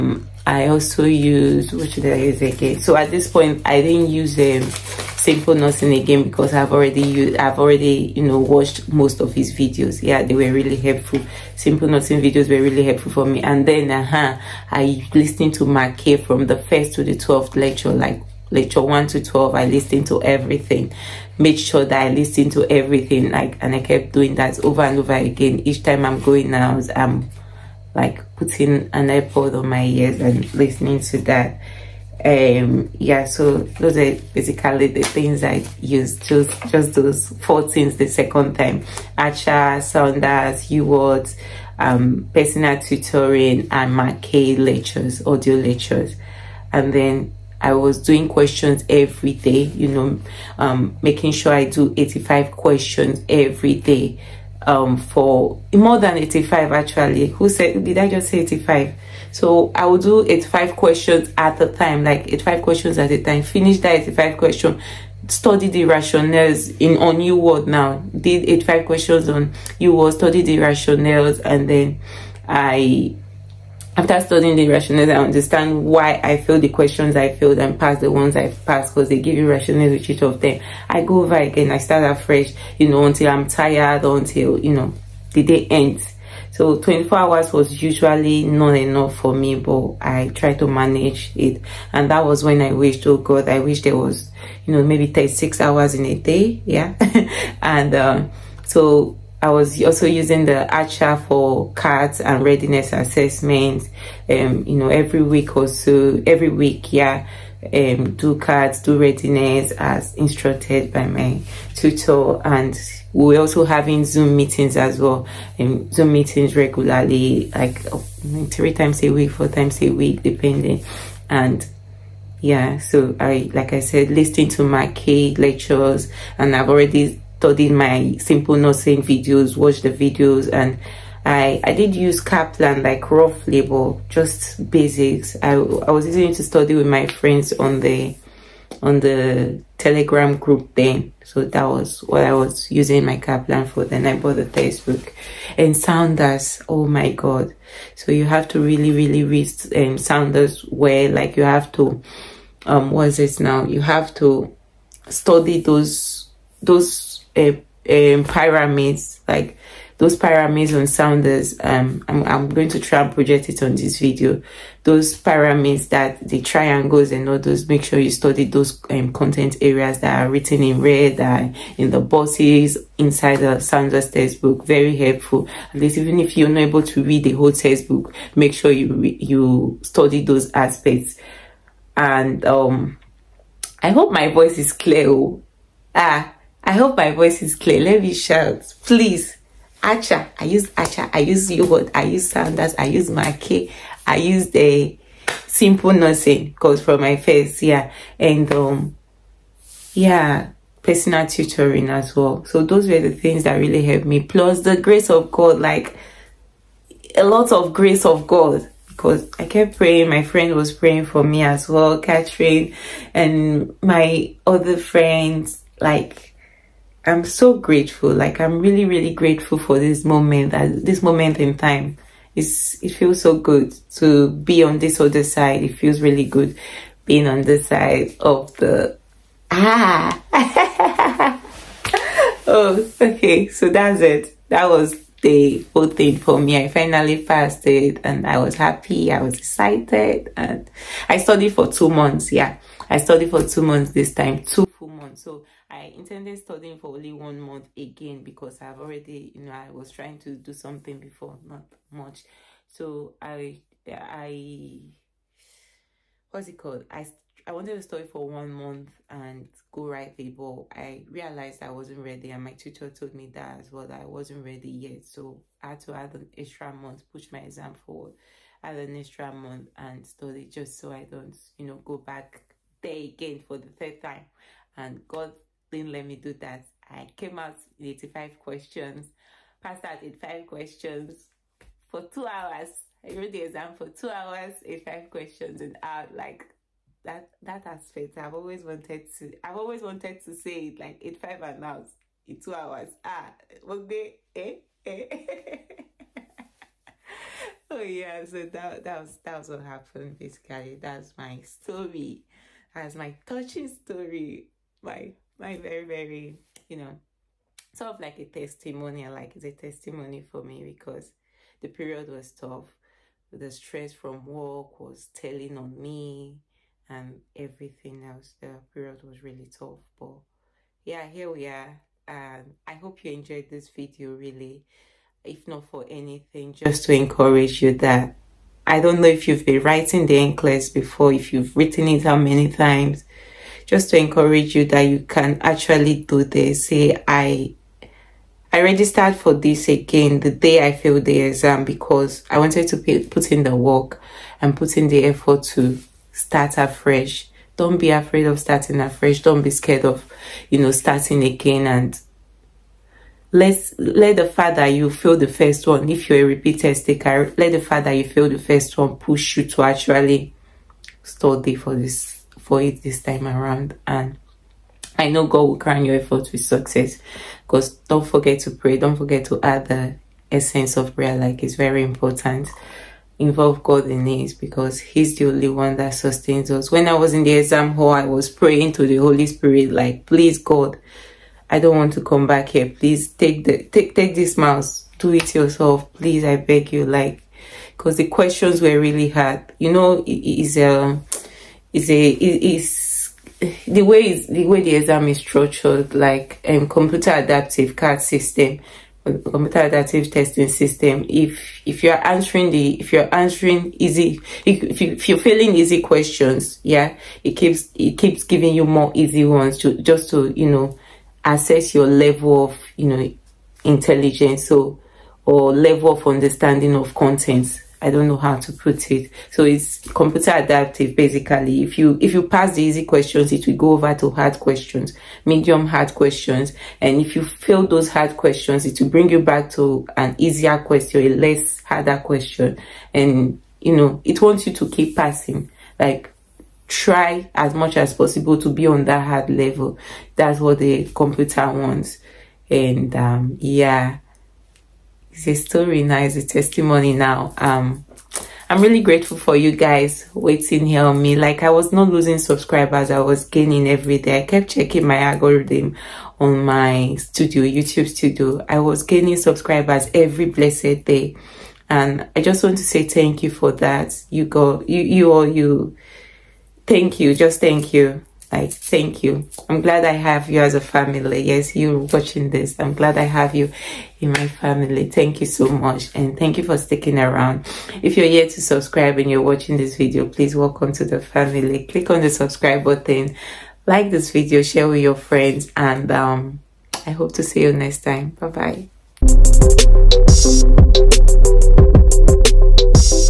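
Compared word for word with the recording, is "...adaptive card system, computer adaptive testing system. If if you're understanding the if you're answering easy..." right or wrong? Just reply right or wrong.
wrong.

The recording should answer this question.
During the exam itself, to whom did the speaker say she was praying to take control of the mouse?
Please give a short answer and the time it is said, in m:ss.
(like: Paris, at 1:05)
The Holy Spirit, at 6:18.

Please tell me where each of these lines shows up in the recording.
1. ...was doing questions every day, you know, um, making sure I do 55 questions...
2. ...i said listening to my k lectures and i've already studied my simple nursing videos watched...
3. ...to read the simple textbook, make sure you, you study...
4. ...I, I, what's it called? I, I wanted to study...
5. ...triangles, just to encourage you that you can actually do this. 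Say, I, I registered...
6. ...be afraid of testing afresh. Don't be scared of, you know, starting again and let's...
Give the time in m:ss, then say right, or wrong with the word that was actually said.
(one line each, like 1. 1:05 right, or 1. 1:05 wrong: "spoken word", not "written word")
1. 0:47 wrong: "85", not "55"
2. 2:03 right
3. 2:56 wrong: "whole", not "simple"
4. 4:13 right
5. 5:32 wrong: "times", not "triangles"
6. 5:47 wrong: "starting", not "testing".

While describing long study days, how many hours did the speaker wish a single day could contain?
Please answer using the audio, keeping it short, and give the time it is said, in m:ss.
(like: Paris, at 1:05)
36, at 1:35.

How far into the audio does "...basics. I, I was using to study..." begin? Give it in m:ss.
2:14.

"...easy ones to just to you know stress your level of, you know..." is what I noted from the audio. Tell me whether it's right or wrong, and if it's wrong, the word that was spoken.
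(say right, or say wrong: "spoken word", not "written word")
wrong: "assess", not "stress".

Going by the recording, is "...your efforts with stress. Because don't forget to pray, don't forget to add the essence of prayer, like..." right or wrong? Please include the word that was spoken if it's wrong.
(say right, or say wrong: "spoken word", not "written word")
wrong: "success", not "stress".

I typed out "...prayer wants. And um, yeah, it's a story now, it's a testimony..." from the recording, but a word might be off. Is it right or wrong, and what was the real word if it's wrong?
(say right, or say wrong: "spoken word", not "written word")
wrong: "computer", not "prayer".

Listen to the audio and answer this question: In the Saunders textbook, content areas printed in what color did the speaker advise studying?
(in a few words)
Red.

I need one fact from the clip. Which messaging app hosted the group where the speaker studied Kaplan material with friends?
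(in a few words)
Telegram.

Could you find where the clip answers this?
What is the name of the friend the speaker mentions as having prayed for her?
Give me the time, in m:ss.
3:31.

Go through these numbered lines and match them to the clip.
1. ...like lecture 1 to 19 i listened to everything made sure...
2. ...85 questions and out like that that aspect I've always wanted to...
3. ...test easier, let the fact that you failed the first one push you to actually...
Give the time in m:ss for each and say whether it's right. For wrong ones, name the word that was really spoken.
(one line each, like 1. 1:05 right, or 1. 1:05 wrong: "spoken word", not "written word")
1. 0:18 wrong: "12", not "19"
2. 4:44 right
3. 5:56 wrong: "taker", not "easier".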